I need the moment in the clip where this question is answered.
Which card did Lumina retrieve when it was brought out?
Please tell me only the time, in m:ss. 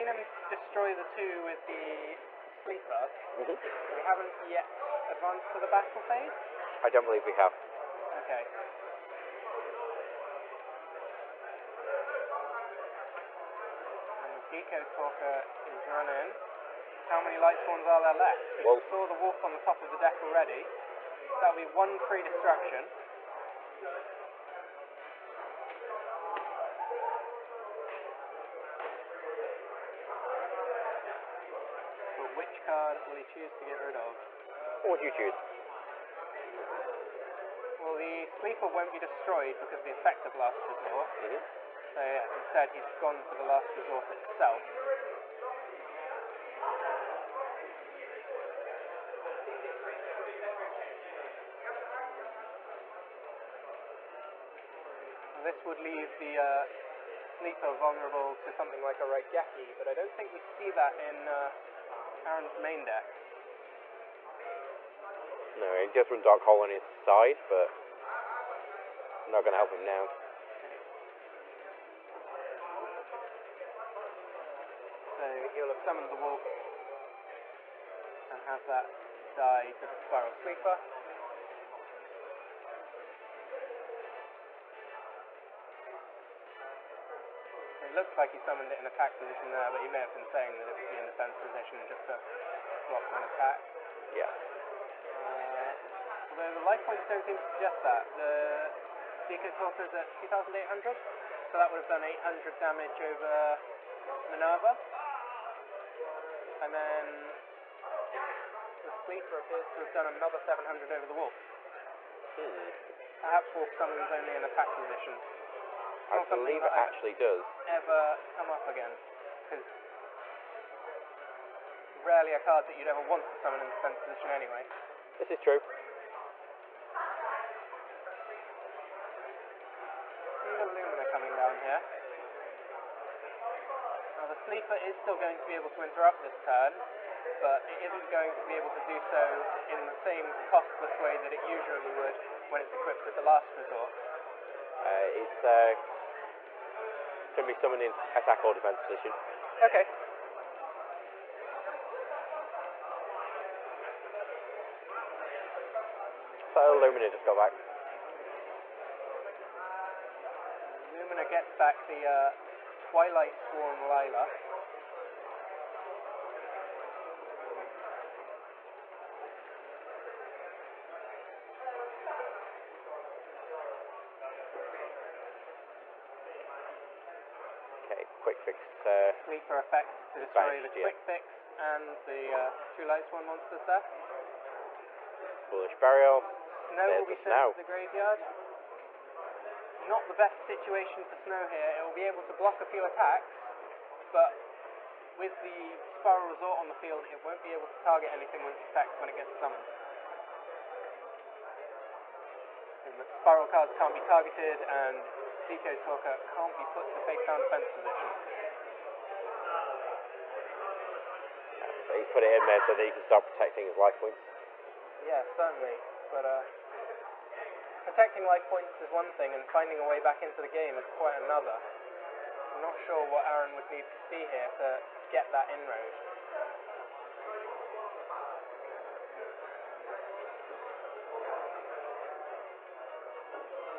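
2:42.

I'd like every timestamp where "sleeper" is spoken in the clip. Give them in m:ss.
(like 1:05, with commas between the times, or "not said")
0:02, 0:38, 0:57, 1:20, 1:49, 2:14, 2:59.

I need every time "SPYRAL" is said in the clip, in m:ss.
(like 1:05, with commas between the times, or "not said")
1:20, 3:15, 3:23.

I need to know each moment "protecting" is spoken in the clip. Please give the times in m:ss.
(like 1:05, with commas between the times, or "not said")
3:33, 3:37.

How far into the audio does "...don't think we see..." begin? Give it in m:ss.
0:59.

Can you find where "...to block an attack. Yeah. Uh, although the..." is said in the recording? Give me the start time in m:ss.
1:32.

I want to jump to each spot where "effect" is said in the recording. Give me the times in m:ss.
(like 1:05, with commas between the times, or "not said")
0:39, 2:59, 3:18.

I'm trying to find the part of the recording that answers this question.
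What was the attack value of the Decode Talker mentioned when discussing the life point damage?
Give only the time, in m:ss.
1:40.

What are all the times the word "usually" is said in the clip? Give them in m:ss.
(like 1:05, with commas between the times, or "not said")
2:21.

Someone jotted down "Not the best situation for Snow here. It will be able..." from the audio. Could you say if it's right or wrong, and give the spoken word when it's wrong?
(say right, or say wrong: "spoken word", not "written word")
right.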